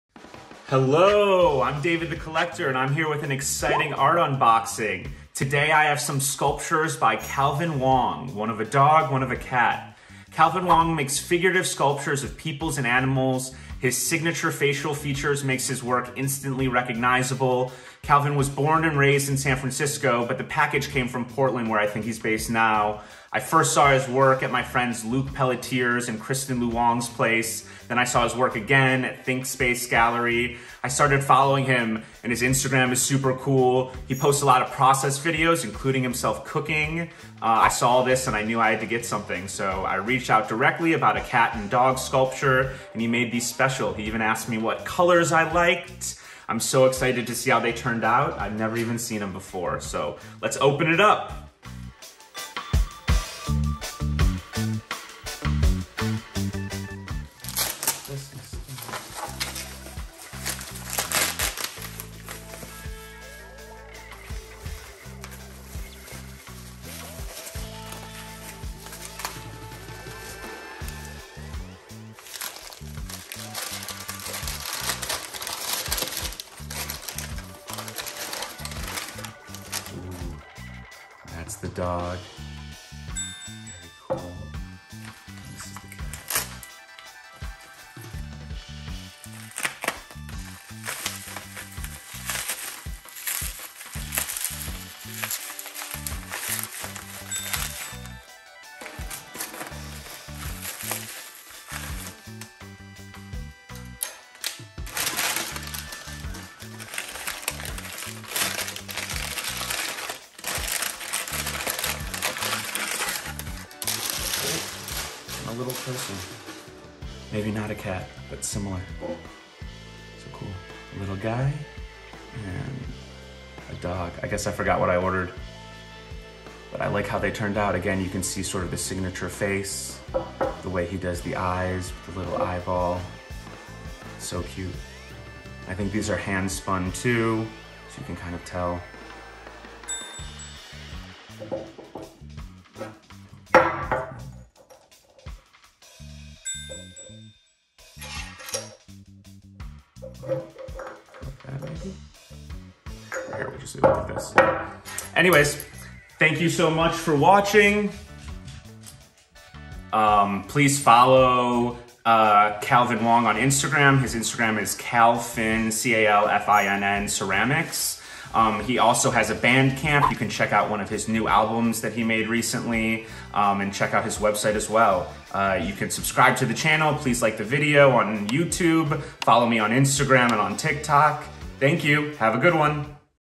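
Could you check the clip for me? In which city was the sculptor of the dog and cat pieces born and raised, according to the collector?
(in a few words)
San Francisco.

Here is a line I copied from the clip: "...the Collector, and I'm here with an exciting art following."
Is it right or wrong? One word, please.
wrong.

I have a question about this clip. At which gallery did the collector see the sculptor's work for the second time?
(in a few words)
Thinkspace Gallery.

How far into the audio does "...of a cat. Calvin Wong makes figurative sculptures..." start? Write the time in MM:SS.
00:09.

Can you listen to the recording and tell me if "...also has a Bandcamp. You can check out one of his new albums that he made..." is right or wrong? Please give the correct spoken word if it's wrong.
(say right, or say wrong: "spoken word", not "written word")
right.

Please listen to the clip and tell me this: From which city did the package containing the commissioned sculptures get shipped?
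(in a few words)
Portland.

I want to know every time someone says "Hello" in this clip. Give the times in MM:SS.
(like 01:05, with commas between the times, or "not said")
00:00.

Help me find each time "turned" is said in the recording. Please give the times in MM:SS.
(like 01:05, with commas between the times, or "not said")
00:47, 02:07.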